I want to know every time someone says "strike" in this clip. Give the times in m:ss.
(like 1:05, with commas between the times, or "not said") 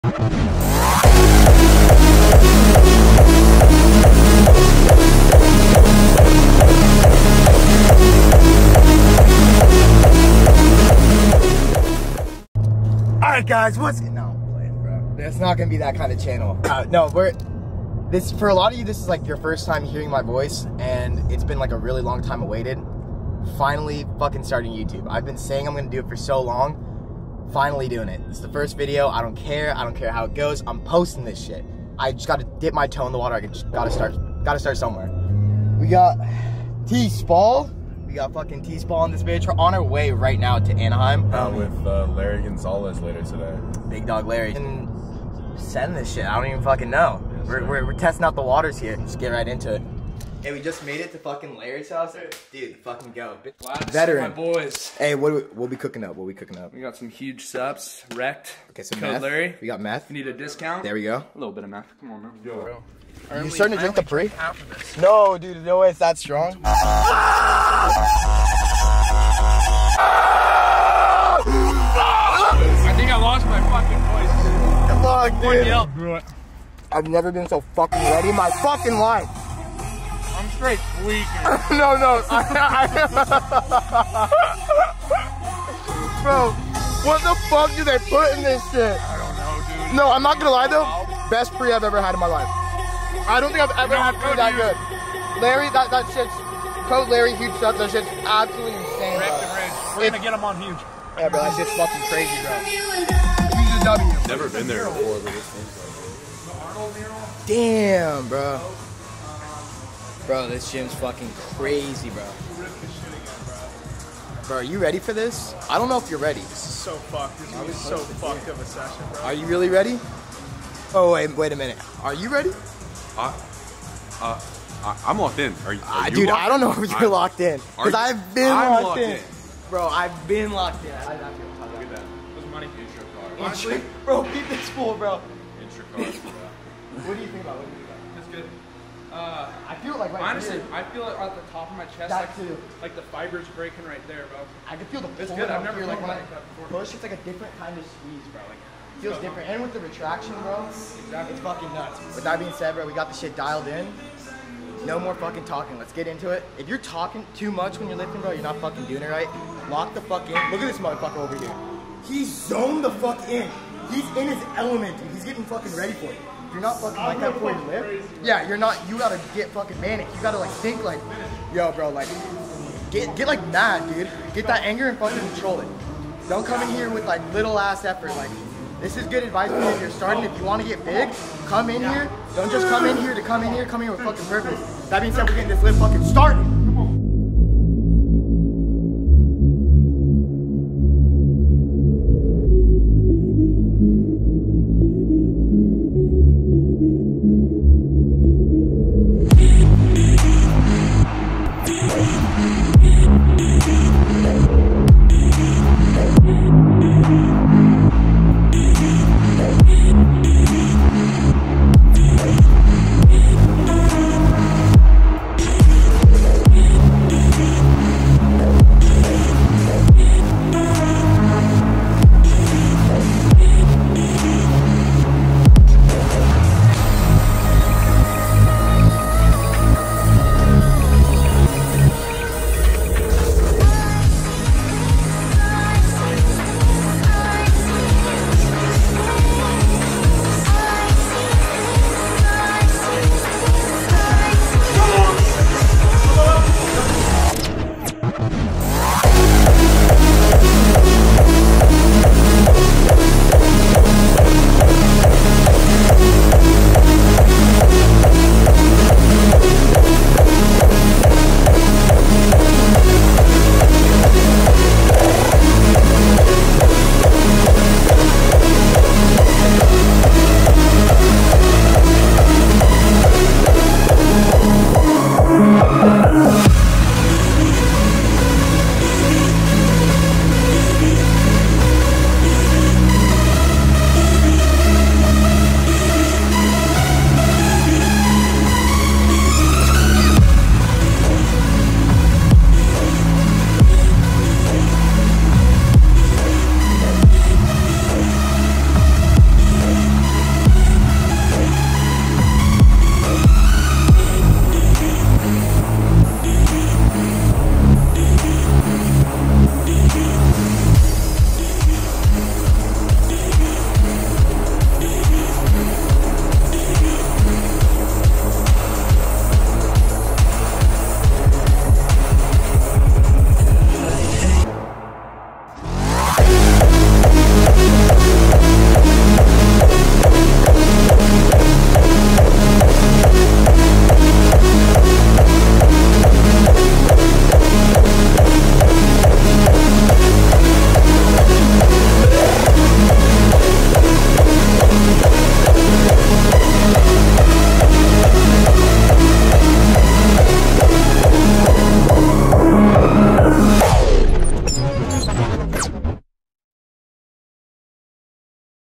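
not said.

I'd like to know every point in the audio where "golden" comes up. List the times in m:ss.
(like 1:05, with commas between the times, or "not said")
not said.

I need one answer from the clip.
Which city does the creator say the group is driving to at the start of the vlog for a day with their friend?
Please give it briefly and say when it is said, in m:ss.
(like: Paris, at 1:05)
Anaheim, at 0:40.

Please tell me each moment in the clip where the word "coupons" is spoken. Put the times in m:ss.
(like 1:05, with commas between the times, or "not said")
not said.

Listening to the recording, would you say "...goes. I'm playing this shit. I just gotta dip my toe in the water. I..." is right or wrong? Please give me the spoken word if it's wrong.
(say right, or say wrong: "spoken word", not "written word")
wrong: "posting", not "playing".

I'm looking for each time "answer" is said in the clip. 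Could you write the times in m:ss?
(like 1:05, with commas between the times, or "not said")
not said.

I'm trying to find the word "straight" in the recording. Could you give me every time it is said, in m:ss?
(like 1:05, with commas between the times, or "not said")
1:20.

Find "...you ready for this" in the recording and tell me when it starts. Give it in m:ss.
1:54.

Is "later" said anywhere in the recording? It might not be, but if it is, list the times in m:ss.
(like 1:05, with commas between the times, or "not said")
0:43.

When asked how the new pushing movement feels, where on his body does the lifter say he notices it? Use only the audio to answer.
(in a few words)
Top of my chest.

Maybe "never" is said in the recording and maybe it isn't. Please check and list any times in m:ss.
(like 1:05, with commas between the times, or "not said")
1:17, 1:44, 2:25.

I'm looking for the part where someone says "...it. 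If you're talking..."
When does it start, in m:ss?
2:36.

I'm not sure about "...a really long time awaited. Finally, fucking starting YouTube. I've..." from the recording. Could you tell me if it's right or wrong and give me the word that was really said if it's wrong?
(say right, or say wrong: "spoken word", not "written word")
right.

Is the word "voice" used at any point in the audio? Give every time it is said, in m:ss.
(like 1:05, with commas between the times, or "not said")
0:20, 1:15.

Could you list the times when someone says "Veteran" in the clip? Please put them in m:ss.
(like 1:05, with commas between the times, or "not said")
0:53.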